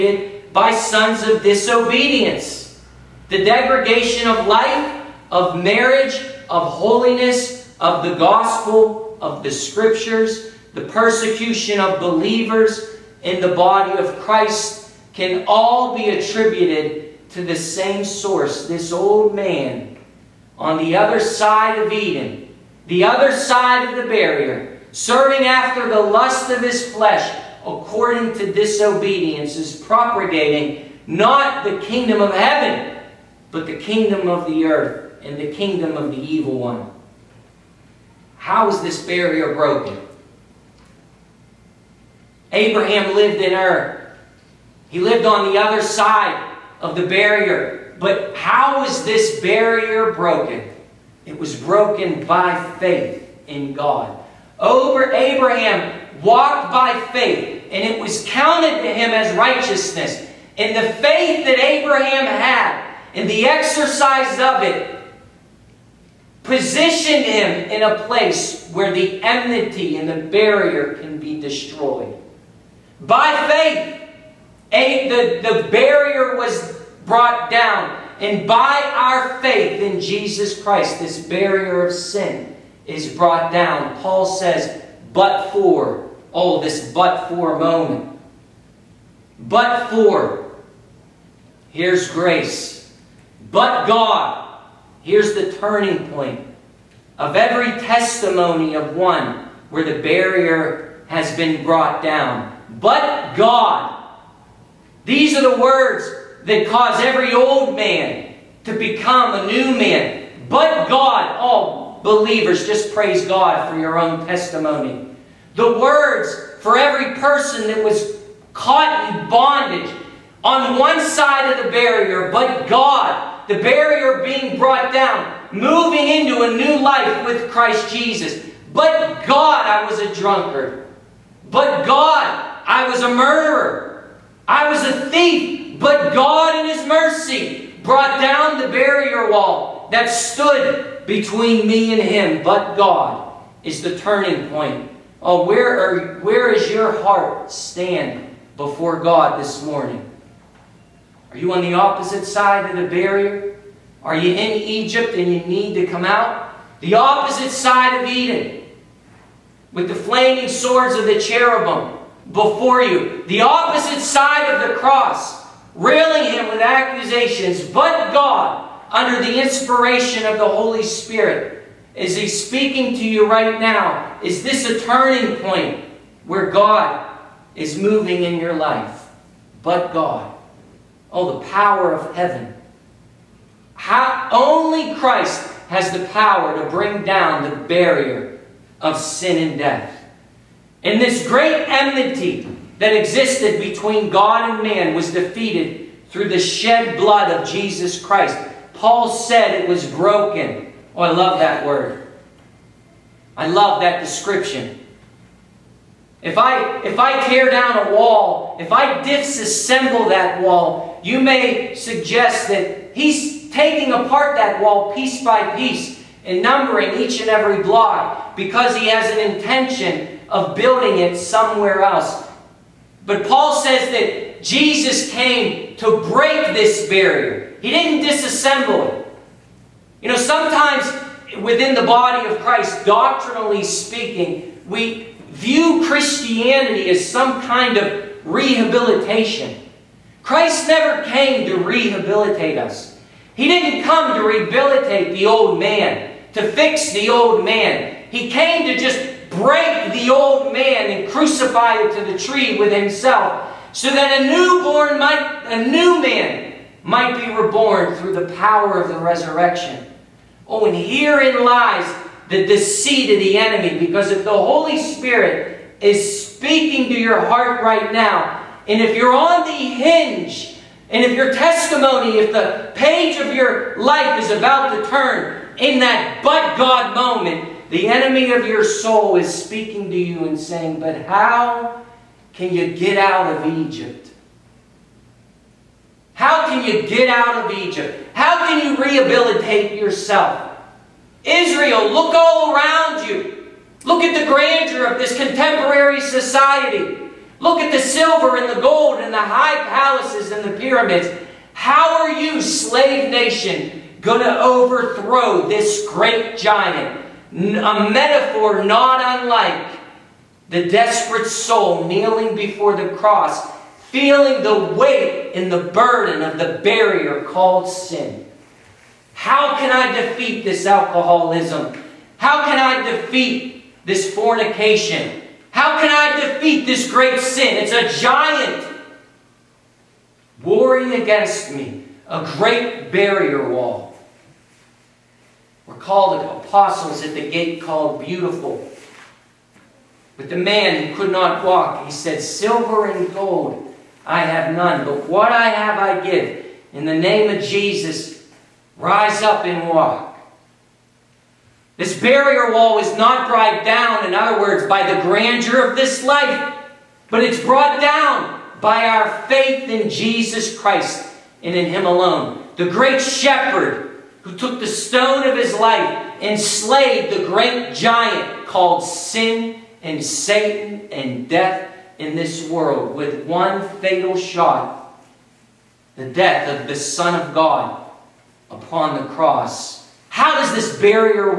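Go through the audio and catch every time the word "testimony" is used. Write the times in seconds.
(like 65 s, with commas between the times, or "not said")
97 s, 114 s, 271 s.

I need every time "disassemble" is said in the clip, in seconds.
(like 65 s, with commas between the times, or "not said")
209 s, 228 s.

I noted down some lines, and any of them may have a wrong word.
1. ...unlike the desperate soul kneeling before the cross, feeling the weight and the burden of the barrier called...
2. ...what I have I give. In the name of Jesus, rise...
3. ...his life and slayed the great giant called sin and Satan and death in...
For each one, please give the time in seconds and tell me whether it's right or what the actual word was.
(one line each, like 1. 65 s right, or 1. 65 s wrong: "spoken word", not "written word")
1. 309 s right
2. 345 s right
3. 365 s right.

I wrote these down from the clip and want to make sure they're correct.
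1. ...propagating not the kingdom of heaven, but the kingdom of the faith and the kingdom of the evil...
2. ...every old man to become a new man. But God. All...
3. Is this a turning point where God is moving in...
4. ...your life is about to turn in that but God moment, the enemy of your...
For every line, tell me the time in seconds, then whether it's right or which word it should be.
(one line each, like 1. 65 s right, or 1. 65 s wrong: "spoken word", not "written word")
1. 29 s wrong: "earth", not "faith"
2. 107 s right
3. 174 s right
4. 273 s right.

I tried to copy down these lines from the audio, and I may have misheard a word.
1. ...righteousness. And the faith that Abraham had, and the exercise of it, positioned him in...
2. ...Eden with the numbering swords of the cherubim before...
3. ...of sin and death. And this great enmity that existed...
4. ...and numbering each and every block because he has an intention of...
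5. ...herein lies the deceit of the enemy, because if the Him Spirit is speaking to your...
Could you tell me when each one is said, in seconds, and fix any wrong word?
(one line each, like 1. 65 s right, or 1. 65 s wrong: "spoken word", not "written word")
1. 59 s right
2. 158 s wrong: "flaming", not "numbering"
3. 188 s right
4. 216 s right
5. 260 s wrong: "Holy", not "Him".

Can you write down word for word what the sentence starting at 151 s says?
Are you on the opposite side of the barrier?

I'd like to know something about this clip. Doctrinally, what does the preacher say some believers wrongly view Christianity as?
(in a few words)
rehabilitation.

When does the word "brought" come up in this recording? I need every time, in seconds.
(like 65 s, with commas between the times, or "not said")
77 s, 83 s, 101 s, 124 s, 137 s, 353 s, 357 s.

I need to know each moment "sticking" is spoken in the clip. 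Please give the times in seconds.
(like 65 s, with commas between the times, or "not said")
not said.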